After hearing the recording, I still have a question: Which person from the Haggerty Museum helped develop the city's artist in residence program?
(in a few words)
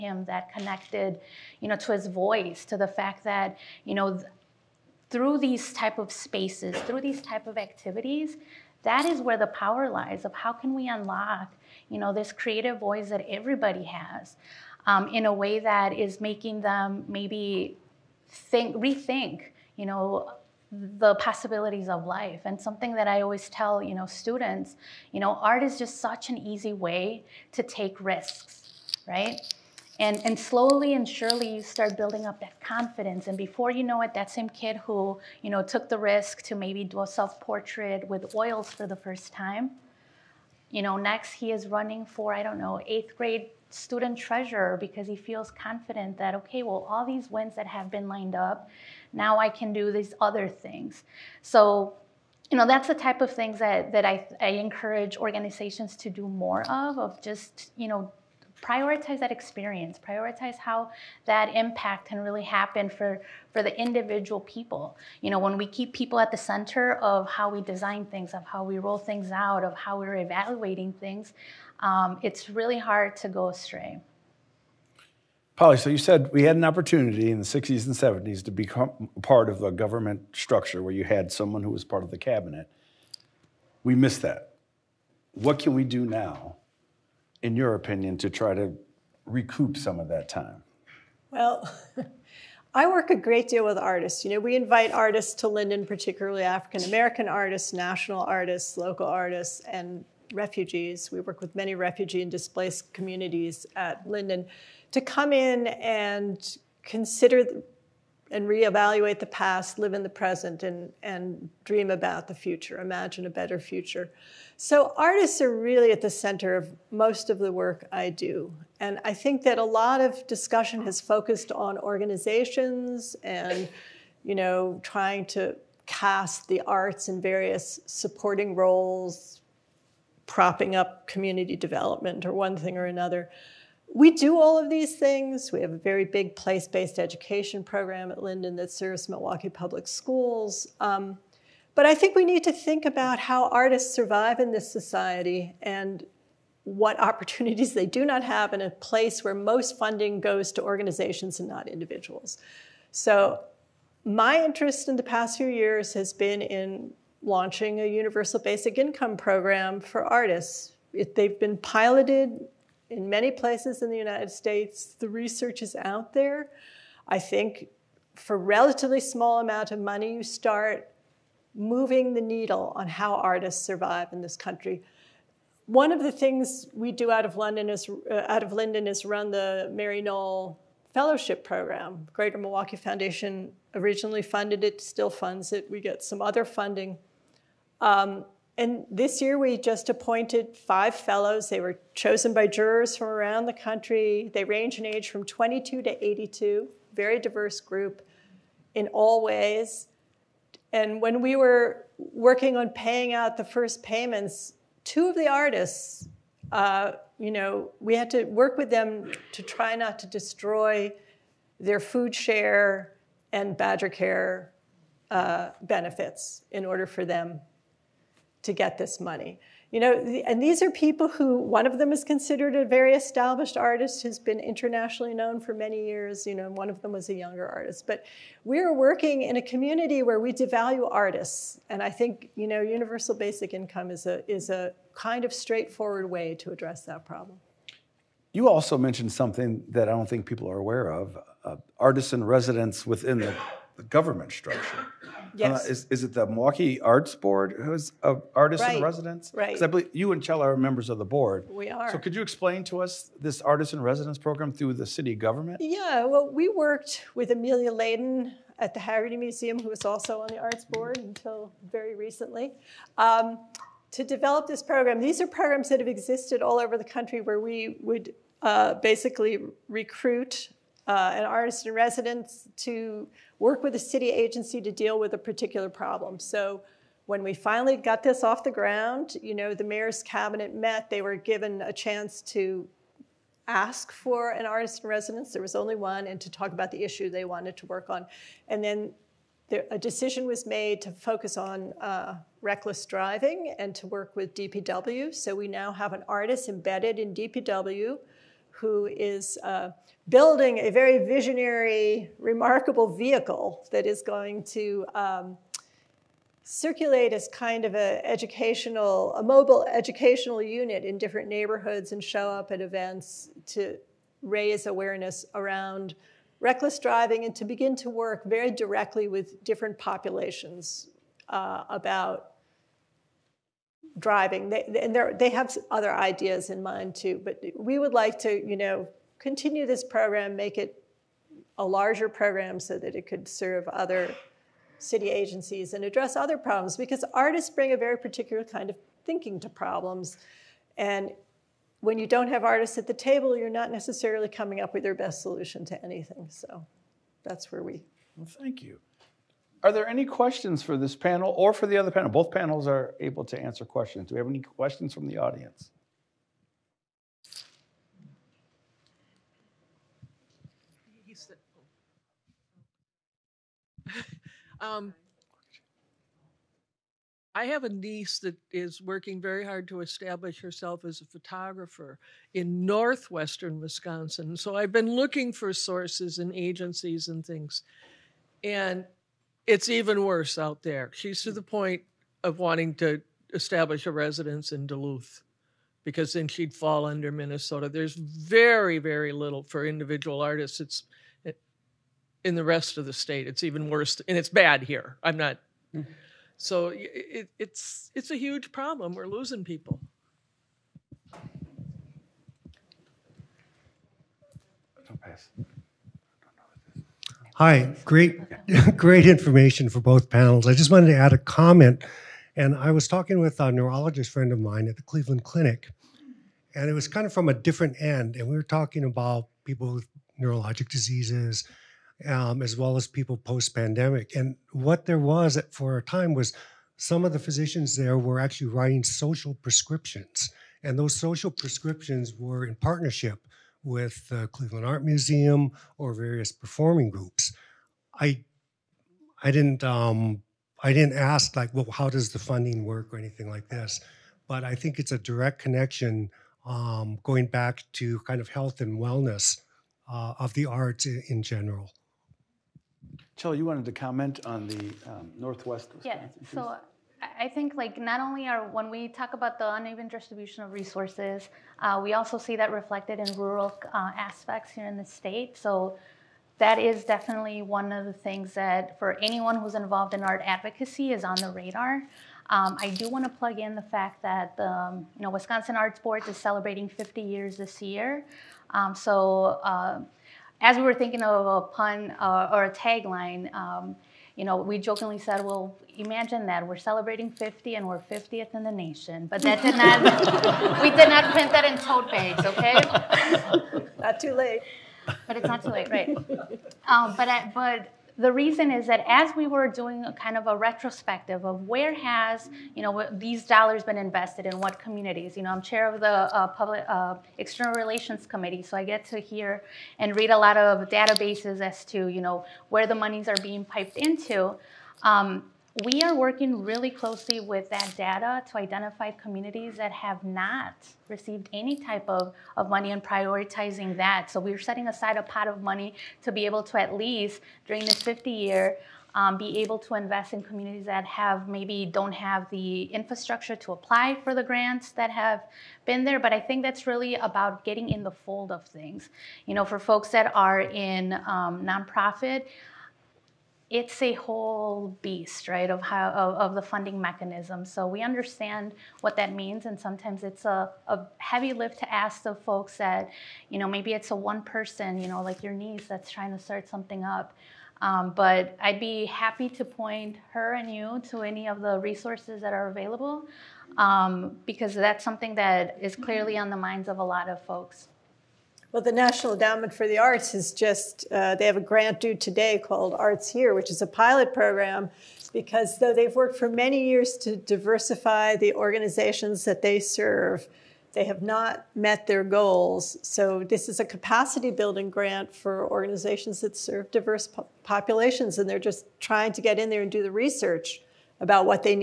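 Emilia Layden.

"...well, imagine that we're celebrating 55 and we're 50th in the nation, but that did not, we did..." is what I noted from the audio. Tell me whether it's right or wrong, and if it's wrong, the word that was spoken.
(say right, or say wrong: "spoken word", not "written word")
wrong: "50", not "55".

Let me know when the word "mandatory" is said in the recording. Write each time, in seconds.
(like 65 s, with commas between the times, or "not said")
not said.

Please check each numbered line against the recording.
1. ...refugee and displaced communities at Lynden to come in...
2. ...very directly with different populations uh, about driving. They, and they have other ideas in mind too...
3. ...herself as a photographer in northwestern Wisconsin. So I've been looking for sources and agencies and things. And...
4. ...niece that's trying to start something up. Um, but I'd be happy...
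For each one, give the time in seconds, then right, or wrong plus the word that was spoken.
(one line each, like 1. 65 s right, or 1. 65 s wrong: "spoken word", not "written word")
1. 101 s right
2. 318 s right
3. 370 s right
4. 555 s right.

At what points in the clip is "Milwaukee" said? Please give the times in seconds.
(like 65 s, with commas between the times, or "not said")
139 s, 182 s, 246 s.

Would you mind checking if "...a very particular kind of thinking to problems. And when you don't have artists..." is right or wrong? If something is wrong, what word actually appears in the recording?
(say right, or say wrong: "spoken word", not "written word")
right.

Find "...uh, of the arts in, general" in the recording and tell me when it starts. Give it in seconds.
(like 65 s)
449 s.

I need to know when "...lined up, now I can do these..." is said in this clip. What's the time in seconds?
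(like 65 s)
48 s.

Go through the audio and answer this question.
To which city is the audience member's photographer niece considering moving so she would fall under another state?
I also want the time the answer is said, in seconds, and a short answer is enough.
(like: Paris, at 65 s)
Duluth, at 384 s.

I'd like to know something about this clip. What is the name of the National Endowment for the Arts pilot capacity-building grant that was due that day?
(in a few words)
Arts Here.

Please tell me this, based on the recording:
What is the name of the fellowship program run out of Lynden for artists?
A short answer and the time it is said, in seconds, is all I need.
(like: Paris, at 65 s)
Mary Nohl Fellowship, at 179 s.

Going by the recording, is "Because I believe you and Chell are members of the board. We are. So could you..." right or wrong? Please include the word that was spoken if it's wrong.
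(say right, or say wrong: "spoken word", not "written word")
right.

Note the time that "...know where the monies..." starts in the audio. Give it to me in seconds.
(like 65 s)
512 s.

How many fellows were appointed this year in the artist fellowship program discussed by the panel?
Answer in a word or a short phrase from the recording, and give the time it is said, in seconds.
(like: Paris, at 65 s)
5, at 190 s.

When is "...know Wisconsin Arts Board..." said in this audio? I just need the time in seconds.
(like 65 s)
475 s.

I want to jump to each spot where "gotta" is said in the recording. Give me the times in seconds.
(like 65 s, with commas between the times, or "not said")
not said.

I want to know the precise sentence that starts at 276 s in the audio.
So when we finally got this off the ground, you know, the mayor's cabinet met.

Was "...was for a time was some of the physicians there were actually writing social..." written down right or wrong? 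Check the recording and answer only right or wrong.
right.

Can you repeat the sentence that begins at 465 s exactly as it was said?
So that is definitely one of the things that for anyone who's involved in art advocacy is on the radar.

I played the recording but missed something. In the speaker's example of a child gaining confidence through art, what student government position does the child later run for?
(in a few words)
eighth grade student treasurer.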